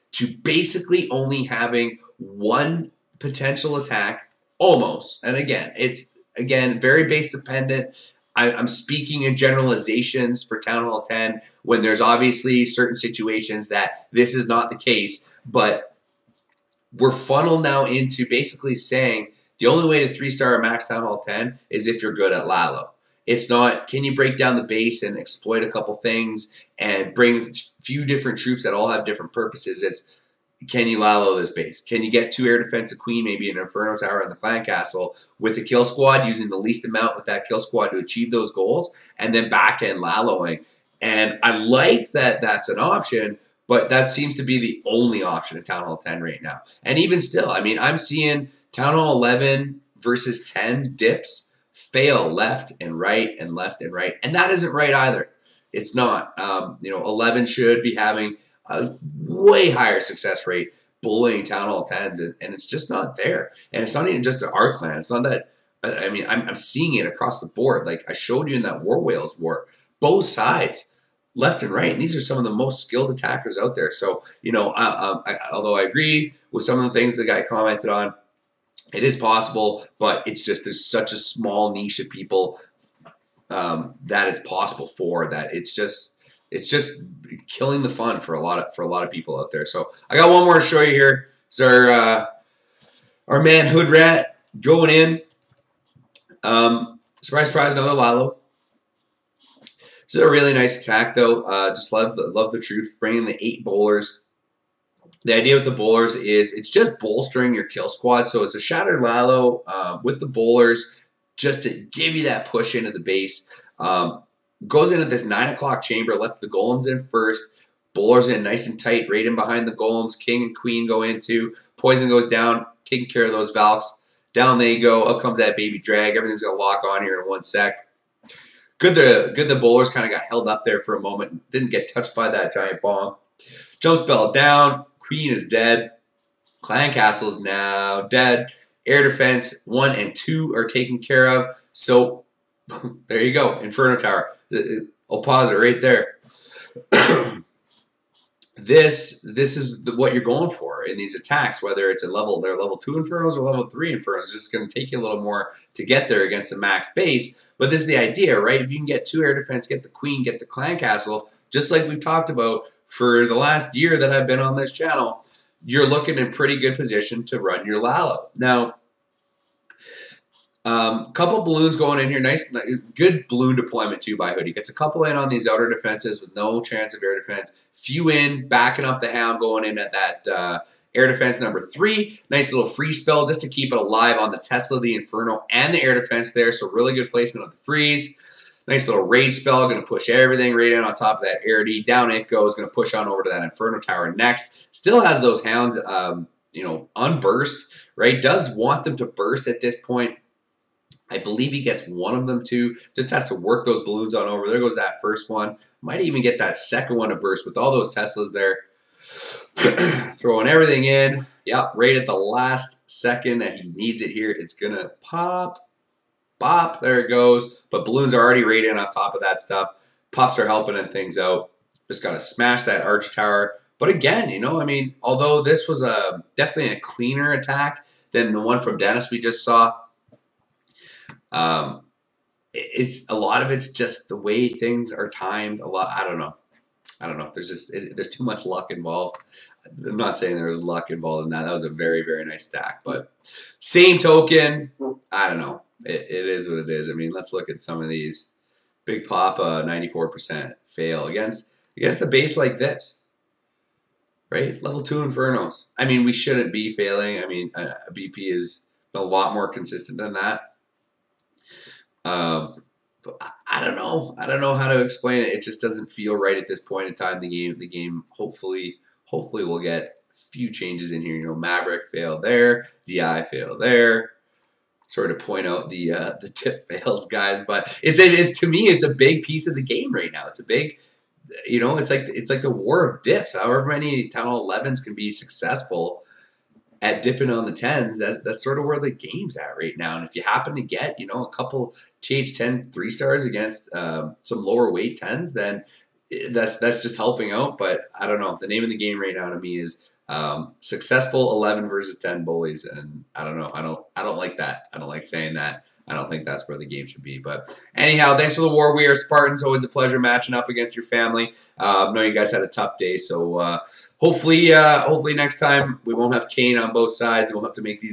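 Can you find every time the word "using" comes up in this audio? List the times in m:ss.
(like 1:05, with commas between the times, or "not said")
0:36.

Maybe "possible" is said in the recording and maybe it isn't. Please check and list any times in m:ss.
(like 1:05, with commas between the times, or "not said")
1:19, 1:24.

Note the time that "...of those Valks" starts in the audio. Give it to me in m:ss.
2:03.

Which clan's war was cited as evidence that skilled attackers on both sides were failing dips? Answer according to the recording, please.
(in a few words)
War Whales.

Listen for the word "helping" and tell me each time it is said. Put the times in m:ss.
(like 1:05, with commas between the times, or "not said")
3:40, 4:56.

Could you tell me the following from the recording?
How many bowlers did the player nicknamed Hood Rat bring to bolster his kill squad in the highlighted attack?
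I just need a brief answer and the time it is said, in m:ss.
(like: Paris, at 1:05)
8, at 1:43.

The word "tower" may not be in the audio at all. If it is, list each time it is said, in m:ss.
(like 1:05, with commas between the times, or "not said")
0:33, 2:23, 3:13, 3:43.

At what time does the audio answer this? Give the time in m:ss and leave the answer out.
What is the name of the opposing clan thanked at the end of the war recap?
5:08.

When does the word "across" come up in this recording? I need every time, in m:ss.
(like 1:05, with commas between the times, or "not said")
1:07.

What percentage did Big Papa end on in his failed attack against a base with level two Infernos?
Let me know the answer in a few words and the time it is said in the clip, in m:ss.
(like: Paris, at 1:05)
94%, at 4:09.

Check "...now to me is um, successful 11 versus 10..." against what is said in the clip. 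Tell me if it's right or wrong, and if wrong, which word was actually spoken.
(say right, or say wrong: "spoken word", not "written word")
right.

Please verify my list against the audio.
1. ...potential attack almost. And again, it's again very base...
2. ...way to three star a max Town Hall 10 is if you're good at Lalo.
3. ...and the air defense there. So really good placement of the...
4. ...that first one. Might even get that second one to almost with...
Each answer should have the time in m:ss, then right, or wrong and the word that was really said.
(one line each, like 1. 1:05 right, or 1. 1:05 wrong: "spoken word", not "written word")
1. 0:03 right
2. 0:19 right
3. 3:05 right
4. 3:24 wrong: "burst", not "almost".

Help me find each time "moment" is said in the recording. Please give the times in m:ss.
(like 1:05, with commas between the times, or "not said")
2:11.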